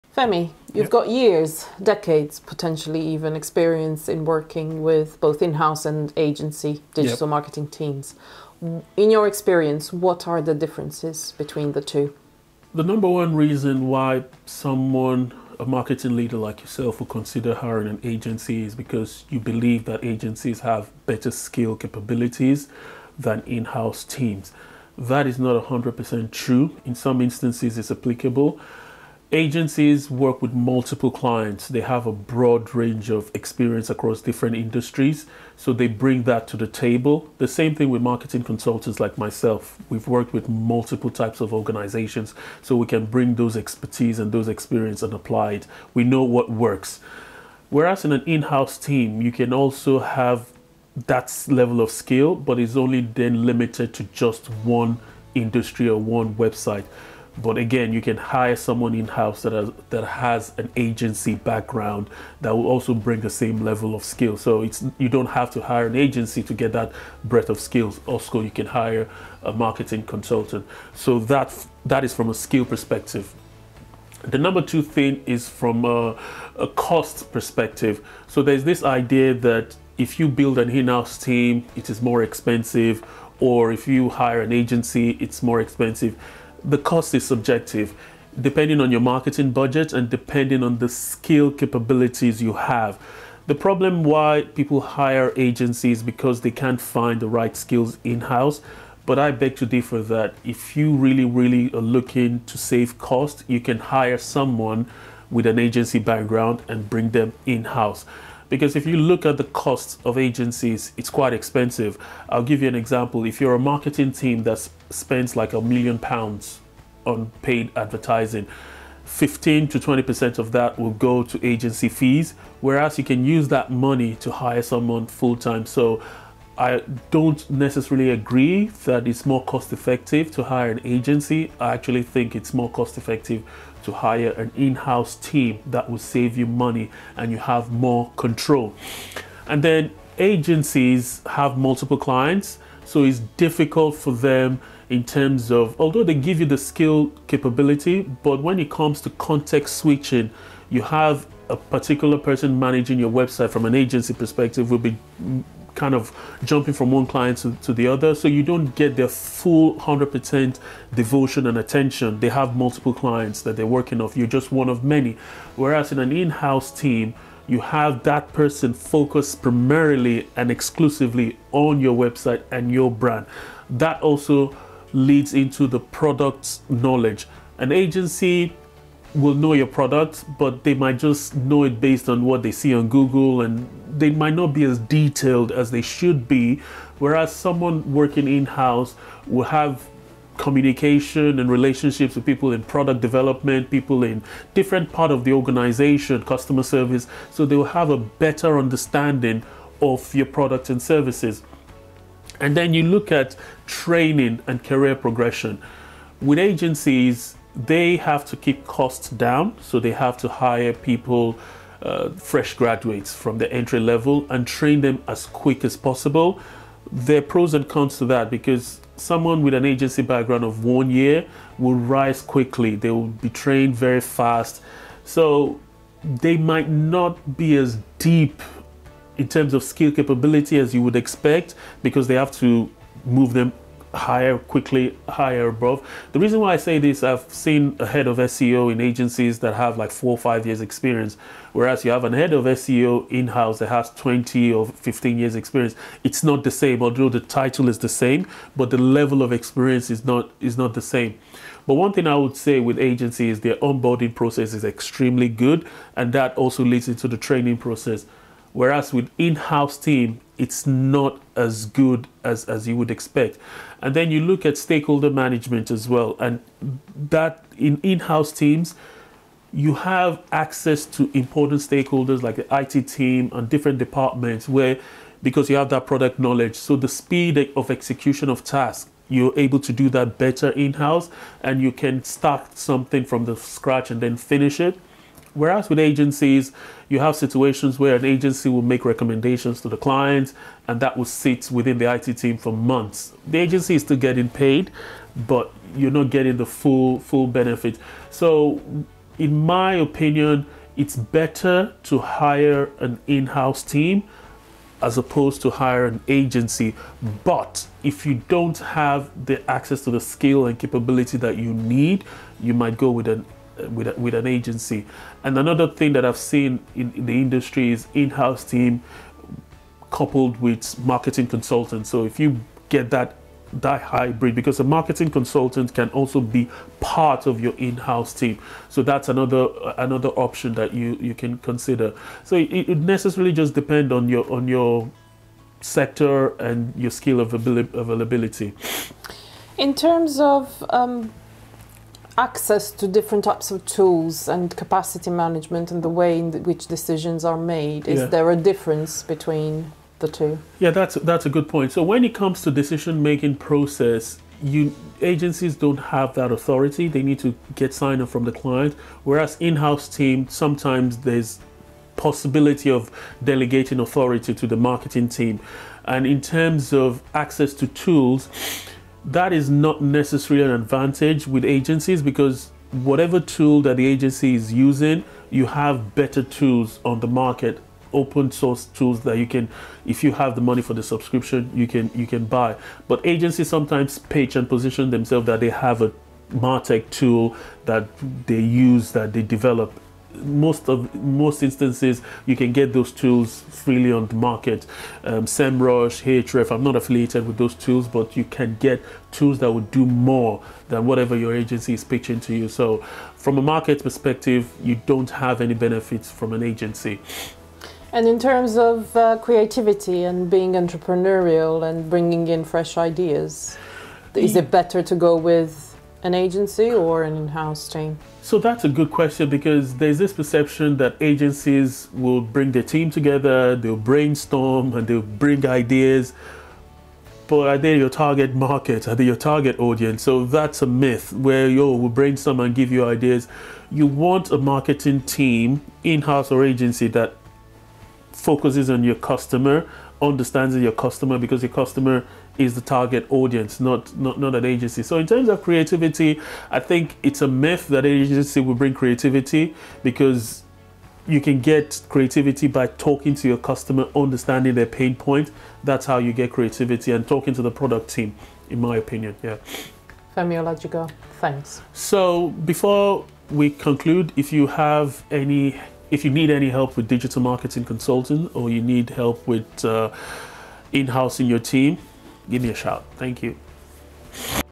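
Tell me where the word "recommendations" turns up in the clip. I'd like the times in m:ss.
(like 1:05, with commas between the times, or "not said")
4:48.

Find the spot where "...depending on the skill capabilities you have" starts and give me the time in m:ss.
1:30.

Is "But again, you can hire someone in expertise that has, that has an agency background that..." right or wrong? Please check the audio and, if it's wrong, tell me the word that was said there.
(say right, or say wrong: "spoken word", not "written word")
wrong: "house", not "expertise".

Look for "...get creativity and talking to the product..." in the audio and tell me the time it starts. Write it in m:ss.
7:36.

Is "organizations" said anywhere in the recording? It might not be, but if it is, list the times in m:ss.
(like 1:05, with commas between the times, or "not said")
0:41, 3:15.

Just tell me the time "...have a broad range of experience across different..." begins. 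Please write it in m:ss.
0:31.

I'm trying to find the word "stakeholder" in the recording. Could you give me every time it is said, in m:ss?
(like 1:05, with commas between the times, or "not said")
4:24, 4:31.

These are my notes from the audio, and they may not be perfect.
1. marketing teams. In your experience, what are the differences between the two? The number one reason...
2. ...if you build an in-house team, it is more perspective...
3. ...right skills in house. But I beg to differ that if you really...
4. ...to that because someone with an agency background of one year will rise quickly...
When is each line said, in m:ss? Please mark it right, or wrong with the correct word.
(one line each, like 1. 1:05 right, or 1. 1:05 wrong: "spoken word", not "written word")
1. 0:07 right
2. 1:19 wrong: "expensive", not "perspective"
3. 1:37 right
4. 3:37 right.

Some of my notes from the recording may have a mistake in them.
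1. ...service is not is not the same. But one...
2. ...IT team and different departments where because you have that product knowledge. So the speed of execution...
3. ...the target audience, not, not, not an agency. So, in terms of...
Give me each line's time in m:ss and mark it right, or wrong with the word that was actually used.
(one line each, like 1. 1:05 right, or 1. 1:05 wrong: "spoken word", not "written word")
1. 4:09 wrong: "experience", not "service"
2. 4:32 right
3. 7:22 right.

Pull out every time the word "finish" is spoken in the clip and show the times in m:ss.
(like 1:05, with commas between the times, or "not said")
4:44.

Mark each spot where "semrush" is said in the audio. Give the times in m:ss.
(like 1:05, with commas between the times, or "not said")
6:35.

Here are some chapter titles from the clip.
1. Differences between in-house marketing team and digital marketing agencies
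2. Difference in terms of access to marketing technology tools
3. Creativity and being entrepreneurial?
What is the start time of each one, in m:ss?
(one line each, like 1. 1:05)
1. 0:12
2. 5:50
3. 6:50.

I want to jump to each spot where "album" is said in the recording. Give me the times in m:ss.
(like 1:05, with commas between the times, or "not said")
not said.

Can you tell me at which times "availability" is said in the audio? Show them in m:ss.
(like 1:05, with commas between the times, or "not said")
5:37.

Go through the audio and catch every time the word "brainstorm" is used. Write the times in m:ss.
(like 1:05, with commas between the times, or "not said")
7:03, 7:11.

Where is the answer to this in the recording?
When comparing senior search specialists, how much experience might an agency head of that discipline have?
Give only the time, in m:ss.
3:59.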